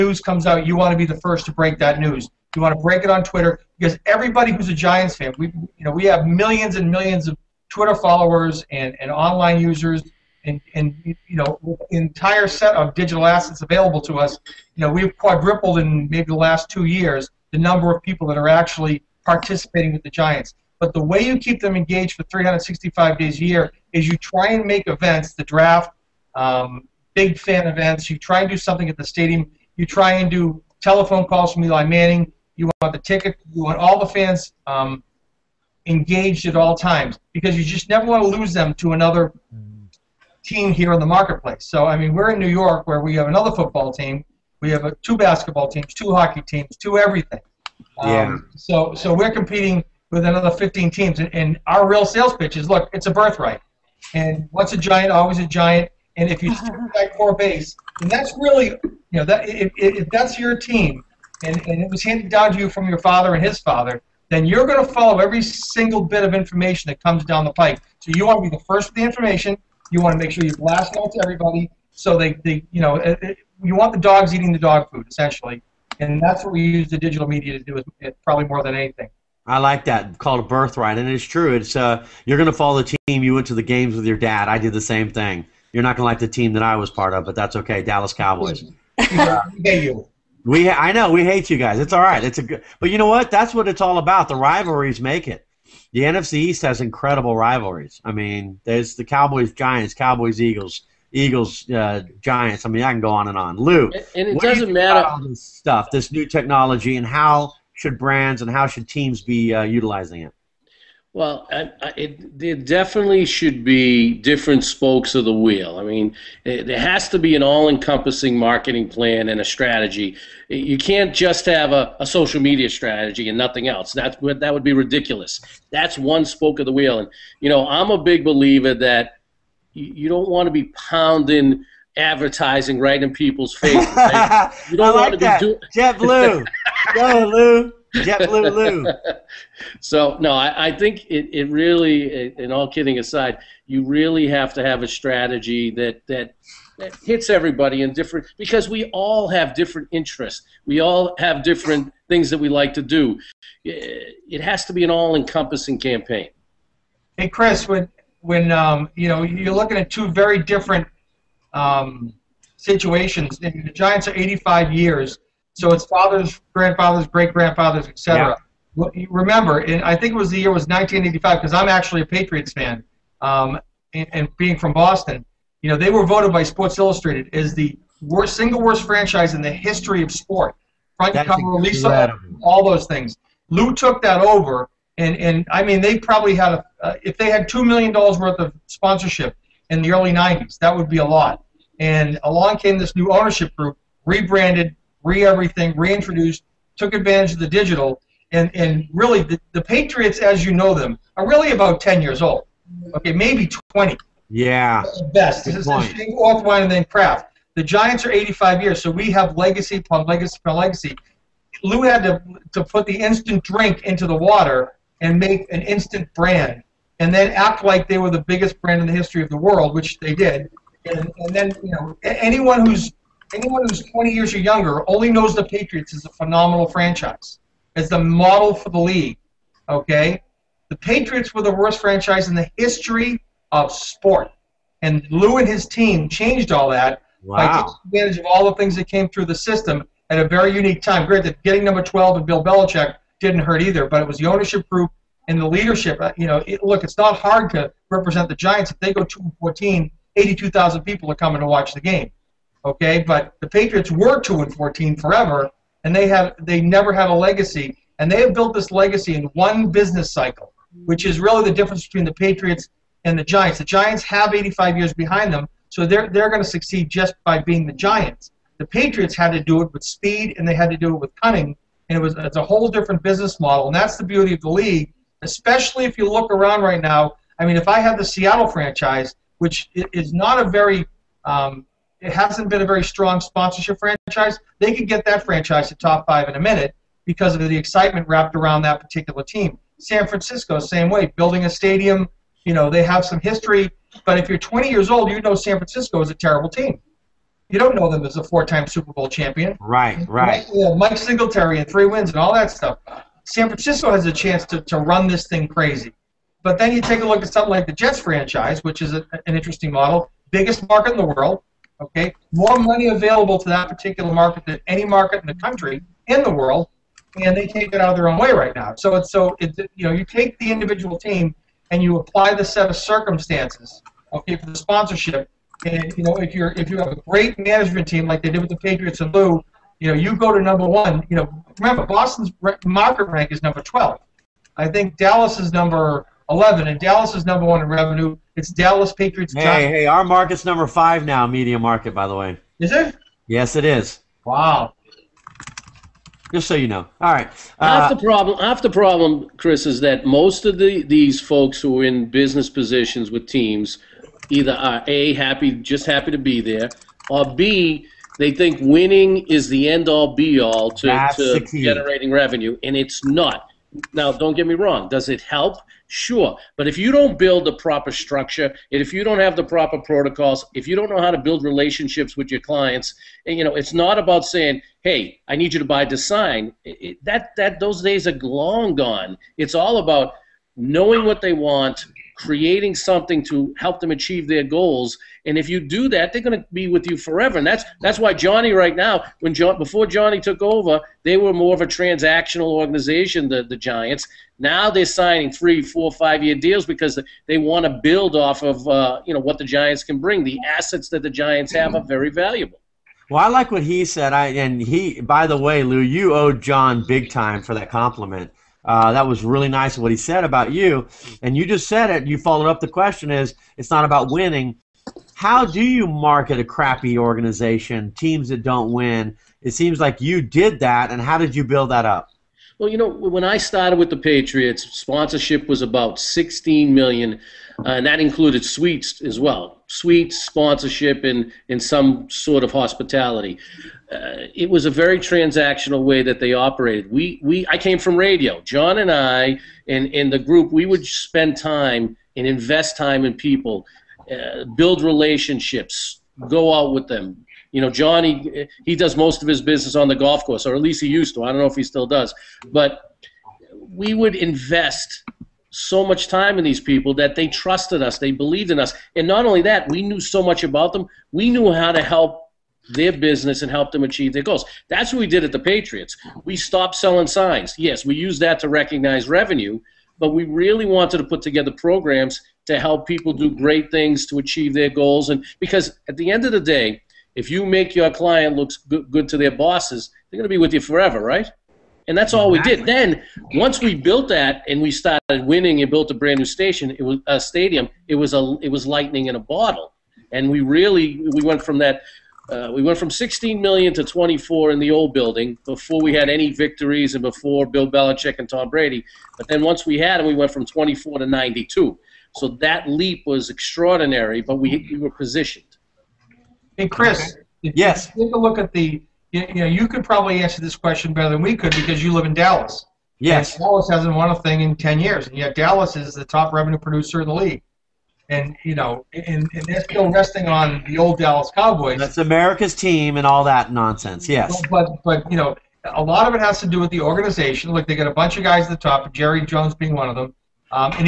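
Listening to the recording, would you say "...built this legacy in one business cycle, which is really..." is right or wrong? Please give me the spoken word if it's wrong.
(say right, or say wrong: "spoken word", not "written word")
right.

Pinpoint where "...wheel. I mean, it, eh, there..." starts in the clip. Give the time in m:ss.
1:55.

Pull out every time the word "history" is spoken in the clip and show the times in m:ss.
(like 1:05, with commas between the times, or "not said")
2:59, 3:38, 3:52, 4:53.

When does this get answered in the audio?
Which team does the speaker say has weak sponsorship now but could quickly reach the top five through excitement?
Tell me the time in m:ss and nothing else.
4:38.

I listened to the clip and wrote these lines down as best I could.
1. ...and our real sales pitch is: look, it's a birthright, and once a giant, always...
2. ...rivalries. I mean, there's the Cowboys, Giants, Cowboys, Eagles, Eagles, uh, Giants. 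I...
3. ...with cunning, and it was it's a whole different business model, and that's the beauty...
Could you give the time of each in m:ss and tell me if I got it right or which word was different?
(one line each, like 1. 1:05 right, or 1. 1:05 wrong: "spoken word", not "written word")
1. 0:51 right
2. 1:37 right
3. 4:30 right.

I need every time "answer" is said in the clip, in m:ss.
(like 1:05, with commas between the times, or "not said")
8:30.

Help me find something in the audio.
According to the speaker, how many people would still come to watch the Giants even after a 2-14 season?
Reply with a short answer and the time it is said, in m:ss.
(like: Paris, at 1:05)
82,000, at 4:10.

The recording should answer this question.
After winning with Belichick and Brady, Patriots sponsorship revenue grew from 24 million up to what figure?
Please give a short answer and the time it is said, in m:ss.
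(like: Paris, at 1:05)
92 million, at 8:21.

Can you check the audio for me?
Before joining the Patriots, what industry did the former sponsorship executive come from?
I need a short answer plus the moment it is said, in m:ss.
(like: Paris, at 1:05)
radio, at 7:17.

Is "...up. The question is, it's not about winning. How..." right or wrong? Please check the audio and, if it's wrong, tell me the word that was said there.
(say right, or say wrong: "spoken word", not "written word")
right.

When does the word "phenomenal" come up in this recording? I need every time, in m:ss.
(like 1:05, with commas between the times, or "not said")
3:46.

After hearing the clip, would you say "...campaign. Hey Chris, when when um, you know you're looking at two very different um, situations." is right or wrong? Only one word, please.
right.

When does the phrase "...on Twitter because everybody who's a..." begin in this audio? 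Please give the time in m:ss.
0:03.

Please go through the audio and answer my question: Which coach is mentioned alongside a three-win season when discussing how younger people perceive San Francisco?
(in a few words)
Mike Singletary.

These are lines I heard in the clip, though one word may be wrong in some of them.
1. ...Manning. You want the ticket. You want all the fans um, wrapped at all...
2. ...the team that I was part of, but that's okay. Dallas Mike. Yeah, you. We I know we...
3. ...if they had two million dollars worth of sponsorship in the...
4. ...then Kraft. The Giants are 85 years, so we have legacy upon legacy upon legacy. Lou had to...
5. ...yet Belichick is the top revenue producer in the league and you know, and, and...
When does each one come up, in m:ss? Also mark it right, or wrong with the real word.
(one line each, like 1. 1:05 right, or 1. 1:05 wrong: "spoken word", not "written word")
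1. 0:31 wrong: "engaged", not "wrapped"
2. 1:26 wrong: "Cowboys", not "Mike"
3. 3:07 right
4. 3:26 right
5. 8:35 wrong: "Dallas", not "Belichick".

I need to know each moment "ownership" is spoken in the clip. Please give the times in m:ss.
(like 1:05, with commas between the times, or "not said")
3:13, 4:04.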